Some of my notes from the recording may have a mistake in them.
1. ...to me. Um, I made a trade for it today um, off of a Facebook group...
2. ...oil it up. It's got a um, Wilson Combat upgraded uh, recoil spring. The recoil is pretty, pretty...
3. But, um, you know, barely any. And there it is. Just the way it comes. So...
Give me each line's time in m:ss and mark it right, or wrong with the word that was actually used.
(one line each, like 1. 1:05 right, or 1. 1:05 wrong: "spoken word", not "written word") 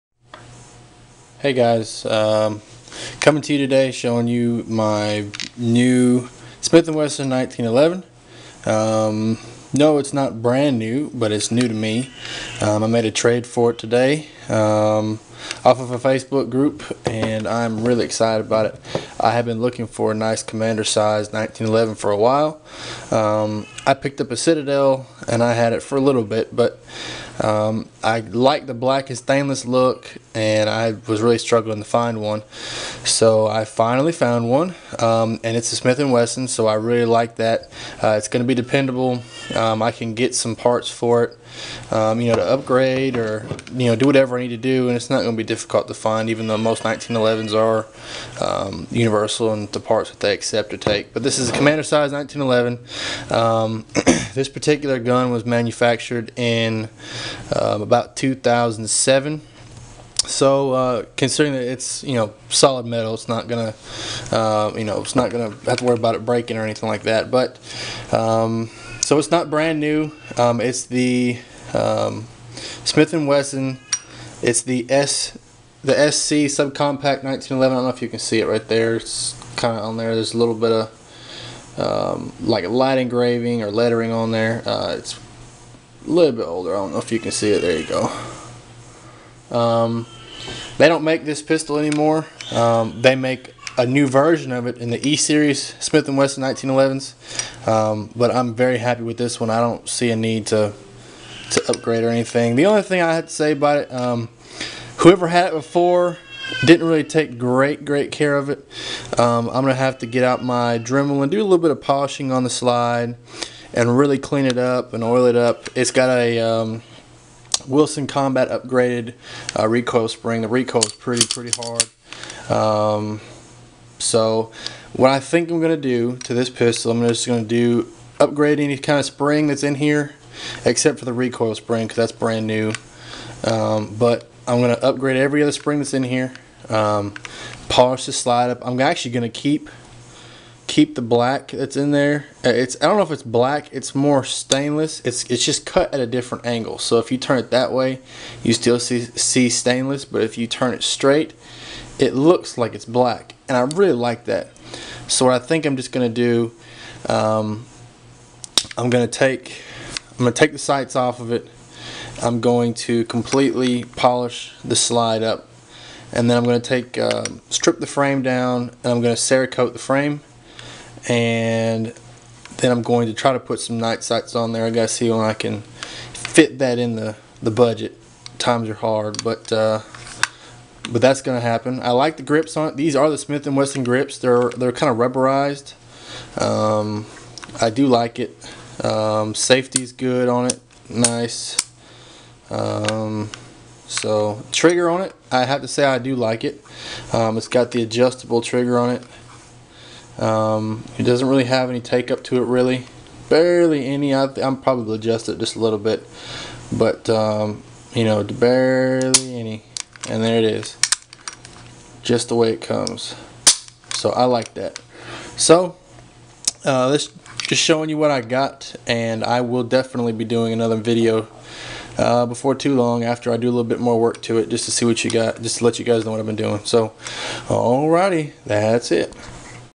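1. 0:11 right
2. 1:55 right
3. 3:26 right.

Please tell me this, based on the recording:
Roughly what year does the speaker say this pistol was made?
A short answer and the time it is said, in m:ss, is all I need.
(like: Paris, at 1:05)
2007, at 0:58.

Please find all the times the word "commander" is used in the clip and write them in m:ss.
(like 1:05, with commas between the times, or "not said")
0:20, 0:51.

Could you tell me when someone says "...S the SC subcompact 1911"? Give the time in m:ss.
1:14.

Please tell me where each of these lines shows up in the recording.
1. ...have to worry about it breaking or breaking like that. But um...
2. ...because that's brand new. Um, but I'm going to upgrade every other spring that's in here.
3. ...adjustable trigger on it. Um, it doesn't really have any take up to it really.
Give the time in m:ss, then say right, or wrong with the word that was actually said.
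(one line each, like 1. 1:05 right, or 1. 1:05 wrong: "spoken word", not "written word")
1. 1:05 wrong: "anything", not "breaking"
2. 2:11 right
3. 3:17 right.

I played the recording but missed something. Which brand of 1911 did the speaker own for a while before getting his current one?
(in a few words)
Citadel.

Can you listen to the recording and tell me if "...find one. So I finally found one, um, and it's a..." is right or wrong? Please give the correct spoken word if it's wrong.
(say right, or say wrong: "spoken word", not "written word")
right.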